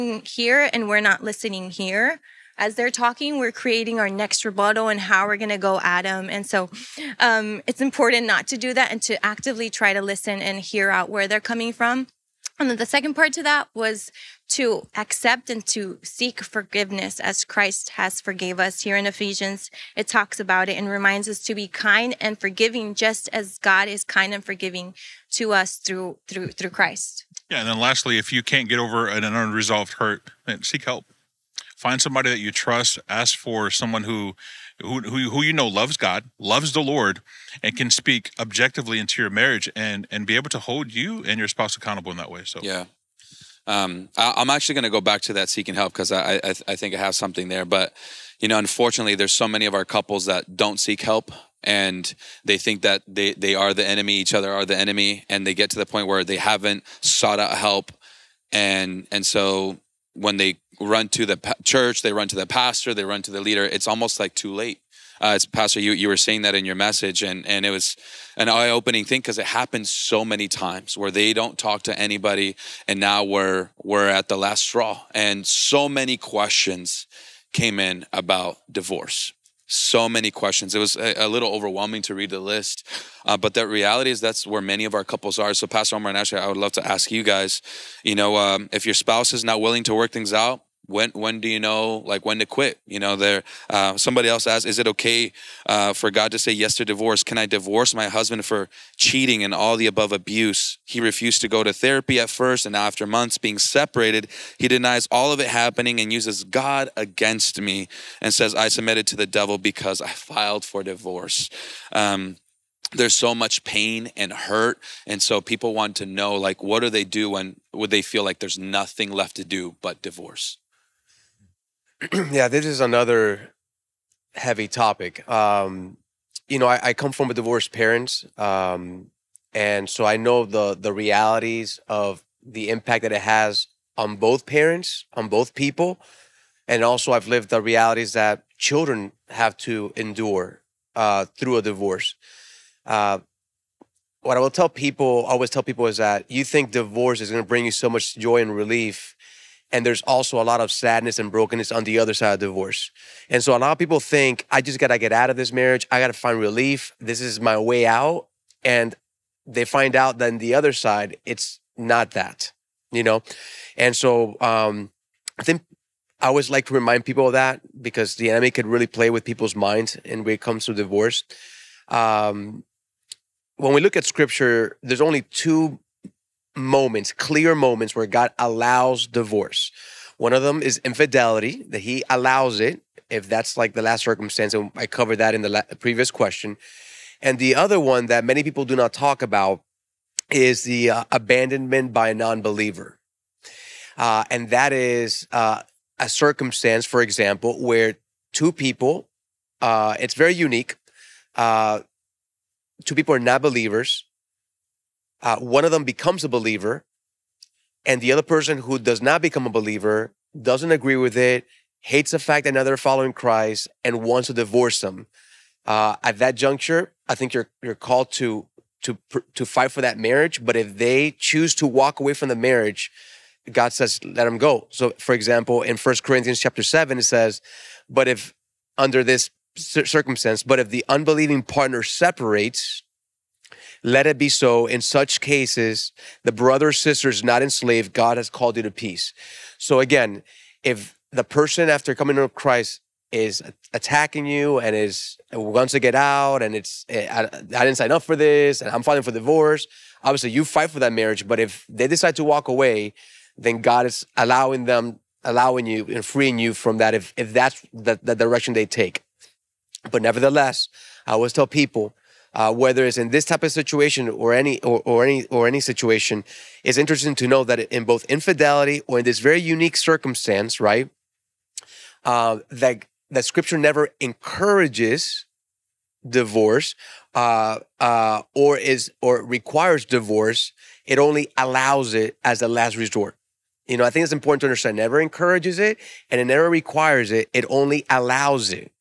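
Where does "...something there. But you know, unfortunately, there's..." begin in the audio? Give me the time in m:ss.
0:47.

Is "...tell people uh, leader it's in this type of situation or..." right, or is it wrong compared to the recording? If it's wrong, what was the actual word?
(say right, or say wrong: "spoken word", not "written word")
wrong: "whether", not "leader".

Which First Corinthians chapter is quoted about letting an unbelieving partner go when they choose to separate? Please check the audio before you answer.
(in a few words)
Chapter 7.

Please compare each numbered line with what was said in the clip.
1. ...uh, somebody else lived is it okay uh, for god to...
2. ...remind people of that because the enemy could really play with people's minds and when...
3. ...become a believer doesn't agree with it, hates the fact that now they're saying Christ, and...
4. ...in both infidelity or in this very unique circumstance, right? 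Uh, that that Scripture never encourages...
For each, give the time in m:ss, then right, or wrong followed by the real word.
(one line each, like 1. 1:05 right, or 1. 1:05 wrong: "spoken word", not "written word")
1. 1:33 wrong: "asked", not "lived"
2. 2:46 right
3. 3:29 wrong: "following", not "saying"
4. 4:27 right.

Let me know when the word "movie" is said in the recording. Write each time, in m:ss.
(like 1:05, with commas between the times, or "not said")
not said.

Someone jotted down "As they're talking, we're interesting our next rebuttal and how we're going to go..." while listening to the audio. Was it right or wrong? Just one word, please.
wrong.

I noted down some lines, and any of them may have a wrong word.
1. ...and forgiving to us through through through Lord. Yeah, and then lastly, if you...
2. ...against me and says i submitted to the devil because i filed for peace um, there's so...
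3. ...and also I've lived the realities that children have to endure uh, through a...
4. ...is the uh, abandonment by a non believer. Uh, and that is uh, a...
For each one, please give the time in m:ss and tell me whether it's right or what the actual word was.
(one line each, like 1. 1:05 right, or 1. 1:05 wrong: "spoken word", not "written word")
1. 0:24 wrong: "Christ", not "Lord"
2. 1:46 wrong: "divorce", not "peace"
3. 2:16 right
4. 3:10 right.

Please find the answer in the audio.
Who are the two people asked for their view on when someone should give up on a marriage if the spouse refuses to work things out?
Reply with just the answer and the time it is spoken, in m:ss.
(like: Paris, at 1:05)
Pastor Omar and Ashley, at 1:25.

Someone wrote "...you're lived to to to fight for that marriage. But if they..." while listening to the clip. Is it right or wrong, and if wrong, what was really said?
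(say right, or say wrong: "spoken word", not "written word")
wrong: "called", not "lived".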